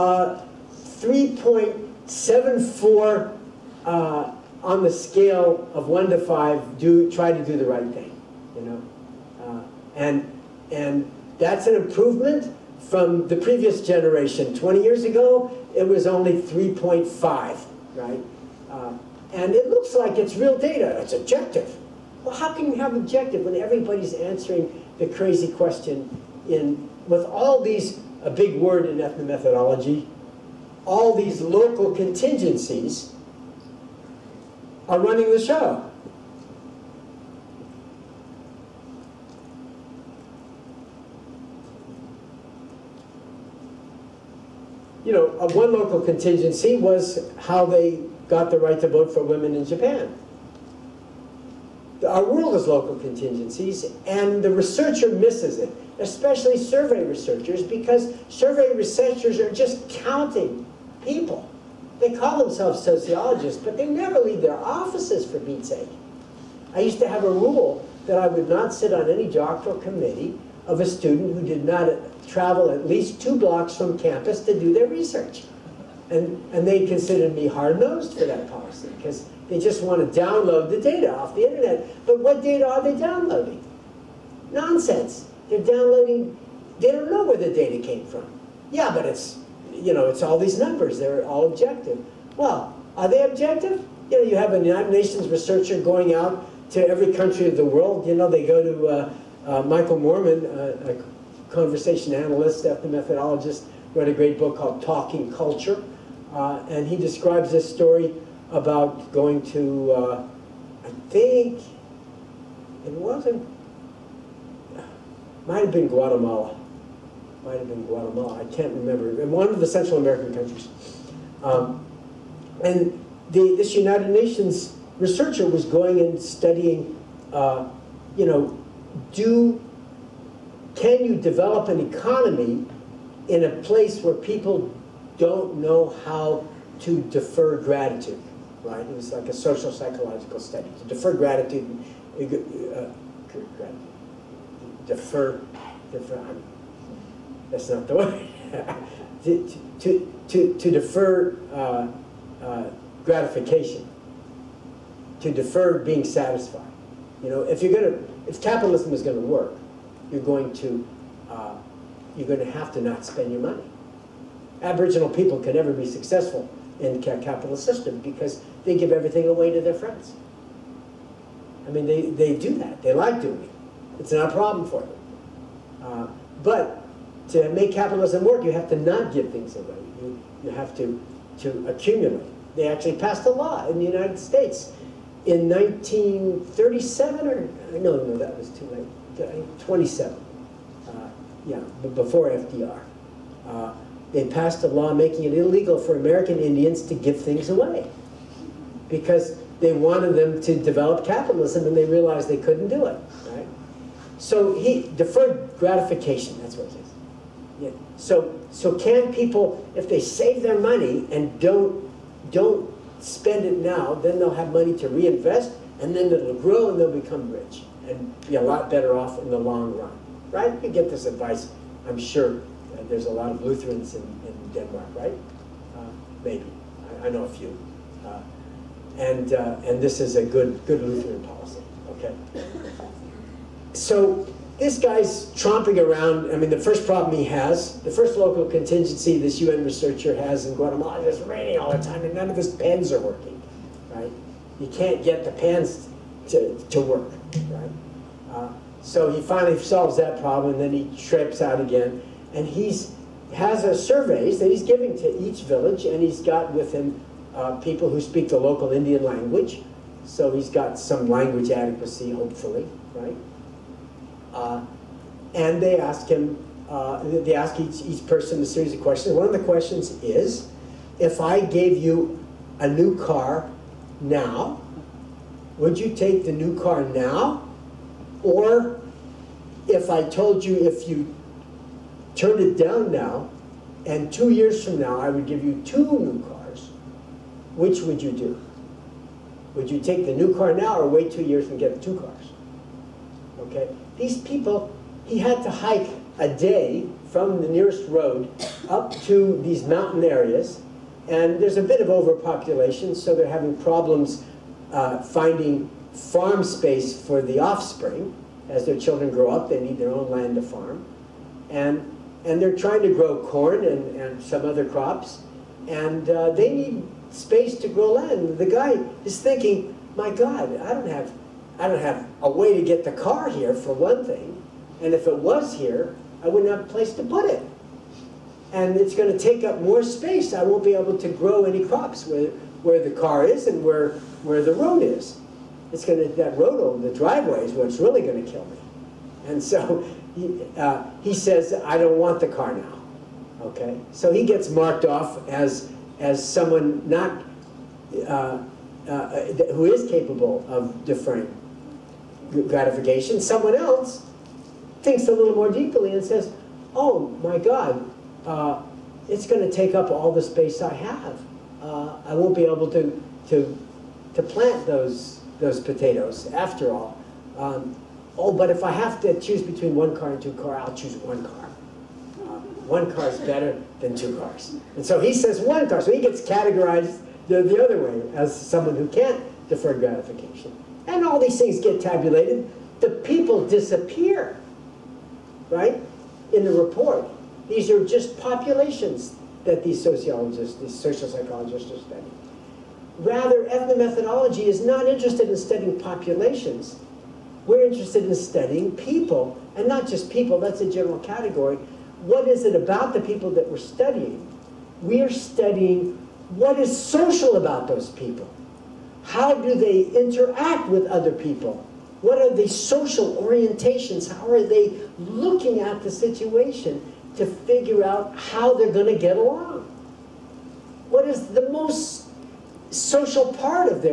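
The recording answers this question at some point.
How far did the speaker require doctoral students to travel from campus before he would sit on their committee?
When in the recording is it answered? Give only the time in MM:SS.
01:13.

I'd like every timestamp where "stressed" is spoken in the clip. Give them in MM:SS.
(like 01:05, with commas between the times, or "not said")
not said.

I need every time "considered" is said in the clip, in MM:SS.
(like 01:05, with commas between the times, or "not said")
01:16.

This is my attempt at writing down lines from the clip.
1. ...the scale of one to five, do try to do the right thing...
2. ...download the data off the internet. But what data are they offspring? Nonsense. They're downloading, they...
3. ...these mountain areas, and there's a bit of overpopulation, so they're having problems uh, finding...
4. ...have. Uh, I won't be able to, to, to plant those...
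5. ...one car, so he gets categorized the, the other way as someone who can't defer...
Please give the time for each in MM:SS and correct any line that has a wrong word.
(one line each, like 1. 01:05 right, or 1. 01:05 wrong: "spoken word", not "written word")
1. 00:04 right
2. 01:20 wrong: "downloading", not "offspring"
3. 04:59 right
4. 06:00 right
5. 06:15 right.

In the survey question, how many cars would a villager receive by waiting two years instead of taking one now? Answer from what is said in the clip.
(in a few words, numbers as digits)
2.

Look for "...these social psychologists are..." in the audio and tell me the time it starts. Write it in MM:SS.
06:30.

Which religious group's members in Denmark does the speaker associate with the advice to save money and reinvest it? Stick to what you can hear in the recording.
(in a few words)
Lutherans.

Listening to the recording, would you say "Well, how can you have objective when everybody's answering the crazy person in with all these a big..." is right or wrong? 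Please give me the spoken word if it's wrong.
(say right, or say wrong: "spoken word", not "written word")
wrong: "question", not "person".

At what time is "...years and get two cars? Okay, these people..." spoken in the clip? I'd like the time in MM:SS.
04:51.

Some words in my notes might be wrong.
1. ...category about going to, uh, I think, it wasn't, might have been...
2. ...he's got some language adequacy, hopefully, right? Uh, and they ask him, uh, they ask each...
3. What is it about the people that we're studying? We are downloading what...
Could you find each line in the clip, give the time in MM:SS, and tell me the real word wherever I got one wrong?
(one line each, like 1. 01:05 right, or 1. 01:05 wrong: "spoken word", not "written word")
1. 01:47 wrong: "story", not "category"
2. 04:20 right
3. 06:42 wrong: "studying", not "downloading".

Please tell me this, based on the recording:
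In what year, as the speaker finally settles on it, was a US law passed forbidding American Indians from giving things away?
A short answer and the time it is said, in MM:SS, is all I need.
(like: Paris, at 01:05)
1927, at 03:09.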